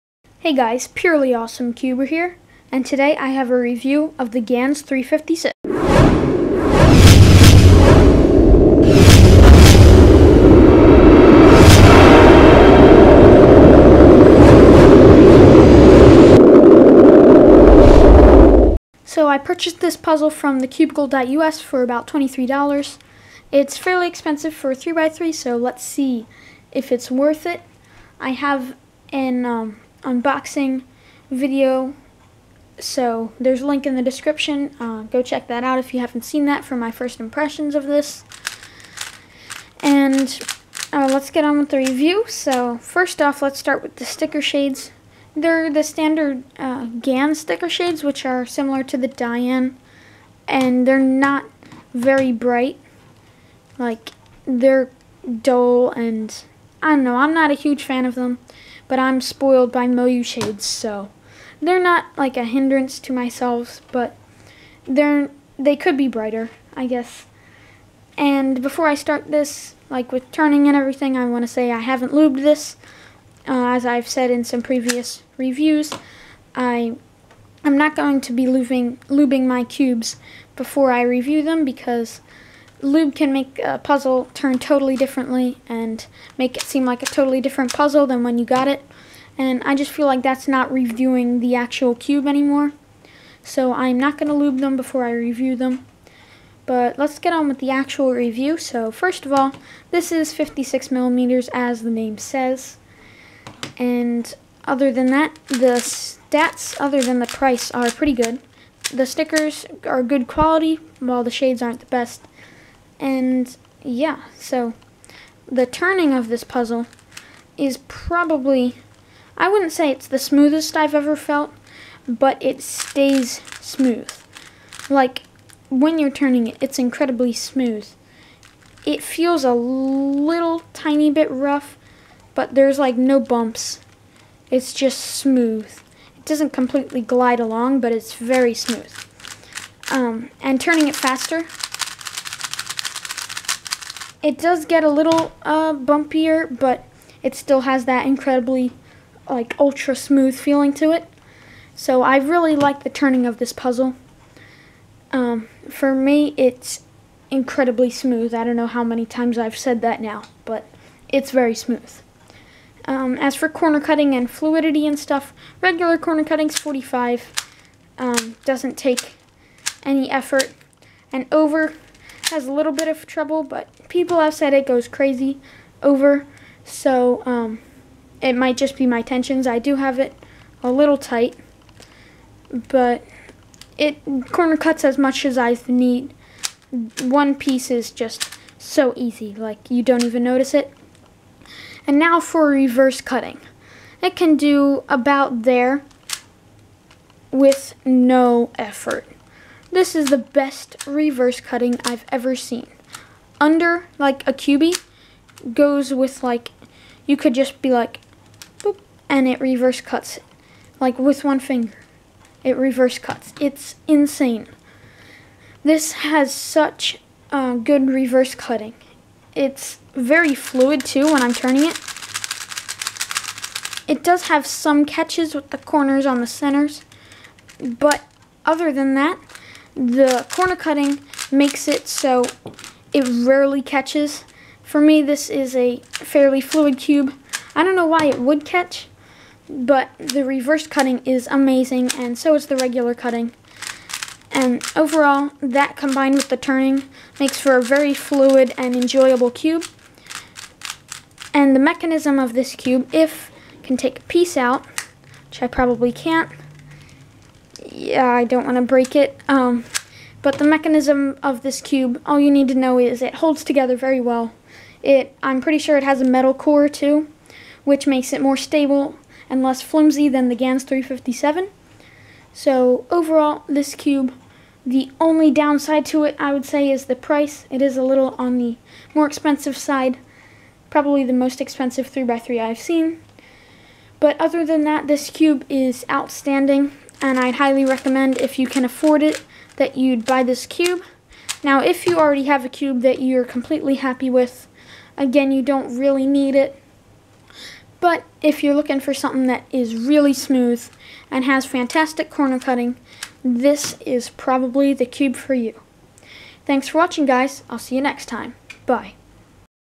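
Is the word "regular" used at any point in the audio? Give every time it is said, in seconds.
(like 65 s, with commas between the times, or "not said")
165 s, 242 s.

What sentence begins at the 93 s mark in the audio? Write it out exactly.
So I'm not going to lube them before I review them.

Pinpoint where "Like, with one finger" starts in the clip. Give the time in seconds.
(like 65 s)
210 s.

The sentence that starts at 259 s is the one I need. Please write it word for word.
Um, but the mechanism of this cube, all you need to know is it holds together very well.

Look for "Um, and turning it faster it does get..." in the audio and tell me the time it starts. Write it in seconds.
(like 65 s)
139 s.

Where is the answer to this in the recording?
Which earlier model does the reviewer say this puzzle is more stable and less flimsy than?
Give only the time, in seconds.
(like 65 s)
270 s.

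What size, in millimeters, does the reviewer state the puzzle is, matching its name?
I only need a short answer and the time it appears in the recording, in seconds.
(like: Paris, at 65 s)
56 millimeters, at 100 s.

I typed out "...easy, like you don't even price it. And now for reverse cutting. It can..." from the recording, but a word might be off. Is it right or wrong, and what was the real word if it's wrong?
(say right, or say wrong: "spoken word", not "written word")
wrong: "notice", not "price".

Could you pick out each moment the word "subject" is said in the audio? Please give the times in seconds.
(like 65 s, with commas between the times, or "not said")
not said.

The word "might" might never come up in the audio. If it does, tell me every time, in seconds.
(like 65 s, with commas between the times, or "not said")
178 s.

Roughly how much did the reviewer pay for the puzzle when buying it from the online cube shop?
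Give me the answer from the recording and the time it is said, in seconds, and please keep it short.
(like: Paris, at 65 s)
$23, at 22 s.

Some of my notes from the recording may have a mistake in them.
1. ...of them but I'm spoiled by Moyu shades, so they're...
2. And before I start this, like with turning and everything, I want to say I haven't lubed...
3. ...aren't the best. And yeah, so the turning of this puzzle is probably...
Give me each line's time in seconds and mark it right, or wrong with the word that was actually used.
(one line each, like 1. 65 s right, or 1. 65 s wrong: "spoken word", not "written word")
1. 58 s right
2. 68 s right
3. 111 s right.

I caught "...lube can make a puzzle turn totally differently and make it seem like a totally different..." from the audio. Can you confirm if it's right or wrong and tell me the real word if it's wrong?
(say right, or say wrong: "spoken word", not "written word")
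right.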